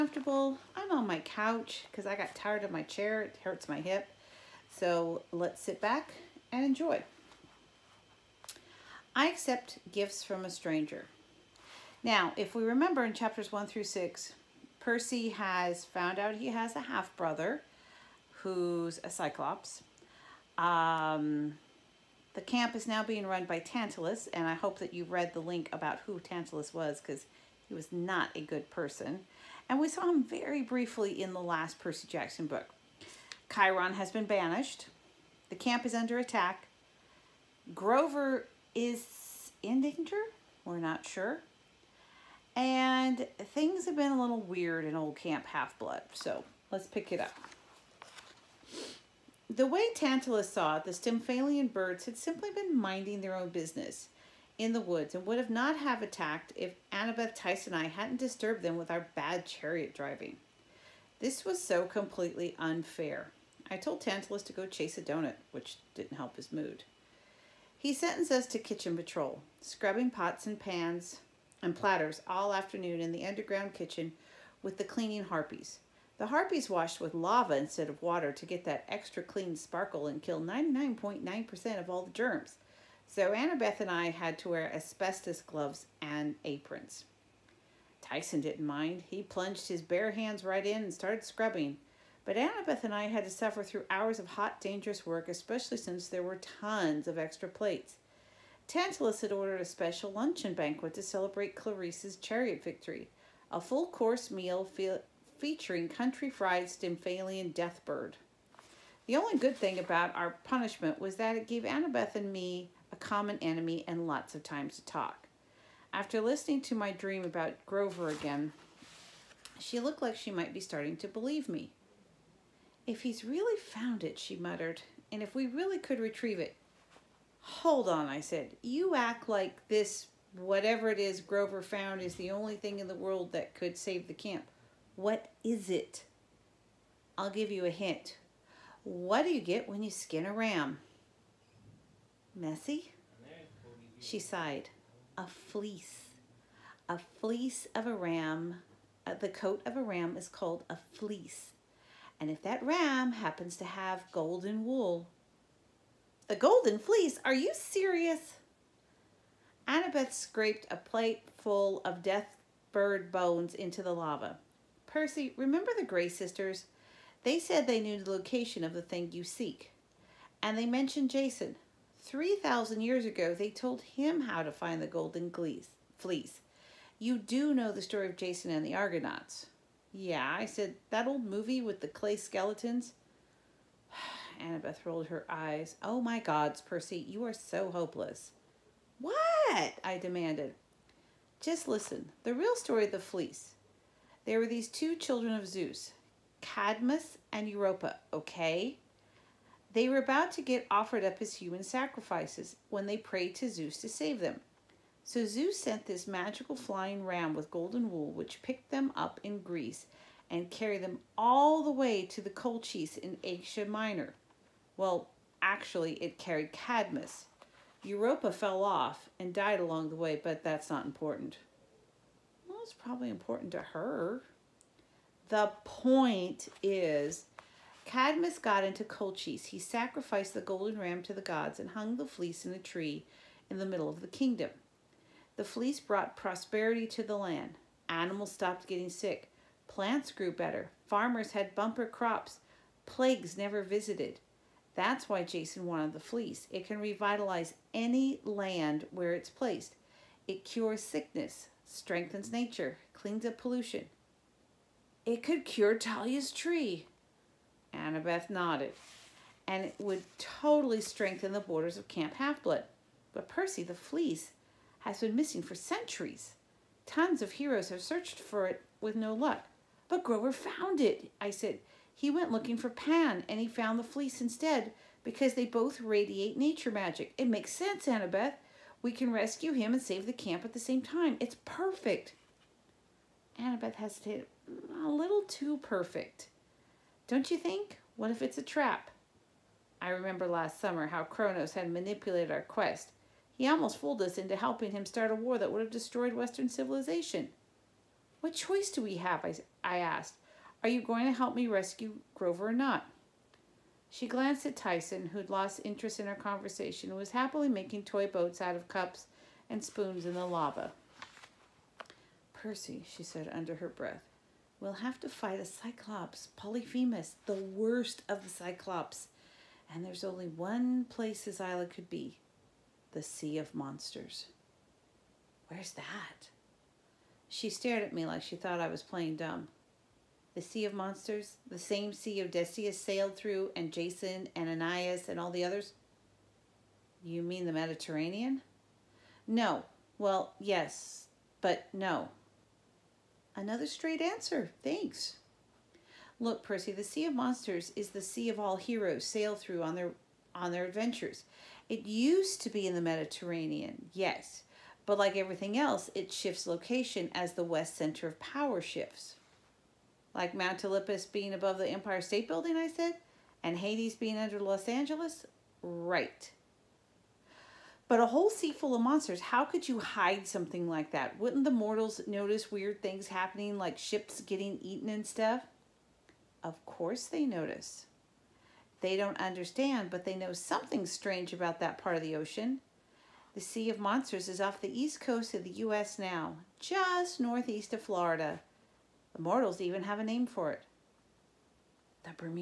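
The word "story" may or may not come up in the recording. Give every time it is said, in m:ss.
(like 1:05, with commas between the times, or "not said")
2:57, 3:12.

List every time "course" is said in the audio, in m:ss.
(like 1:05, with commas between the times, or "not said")
1:43, 6:16.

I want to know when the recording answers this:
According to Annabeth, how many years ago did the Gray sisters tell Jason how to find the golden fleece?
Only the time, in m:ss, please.
2:52.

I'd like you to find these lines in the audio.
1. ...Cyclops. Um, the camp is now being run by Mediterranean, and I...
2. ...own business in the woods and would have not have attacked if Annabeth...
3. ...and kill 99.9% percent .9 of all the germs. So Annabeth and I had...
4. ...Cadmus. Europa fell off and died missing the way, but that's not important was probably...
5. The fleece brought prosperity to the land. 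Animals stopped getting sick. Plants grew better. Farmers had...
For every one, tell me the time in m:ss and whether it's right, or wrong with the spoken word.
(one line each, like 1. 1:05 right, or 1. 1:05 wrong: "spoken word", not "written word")
1. 0:19 wrong: "Tantalus", not "Mediterranean"
2. 0:53 right
3. 1:20 right
4. 3:36 wrong: "along", not "missing"
5. 3:55 right.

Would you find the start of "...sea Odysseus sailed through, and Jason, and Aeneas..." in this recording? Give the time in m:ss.
5:31.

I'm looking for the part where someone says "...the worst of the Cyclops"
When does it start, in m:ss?
5:17.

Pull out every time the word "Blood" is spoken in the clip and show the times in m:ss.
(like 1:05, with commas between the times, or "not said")
0:45, 4:22.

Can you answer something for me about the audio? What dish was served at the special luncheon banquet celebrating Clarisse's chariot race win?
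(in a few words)
Country fried Stymphalian deathbird.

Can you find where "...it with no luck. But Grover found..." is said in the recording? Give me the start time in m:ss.
4:28.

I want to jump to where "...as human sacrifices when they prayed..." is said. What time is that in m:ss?
3:21.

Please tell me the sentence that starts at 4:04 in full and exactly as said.
That's why Jason wanted the fleece.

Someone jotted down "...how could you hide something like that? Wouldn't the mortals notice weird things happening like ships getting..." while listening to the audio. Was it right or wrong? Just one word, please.
right.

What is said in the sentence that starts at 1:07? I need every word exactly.
He sentenced us to kitchen patrol, scrubbing pots and pans and platters all afternoon in the underground kitchen with the cleaning harpies.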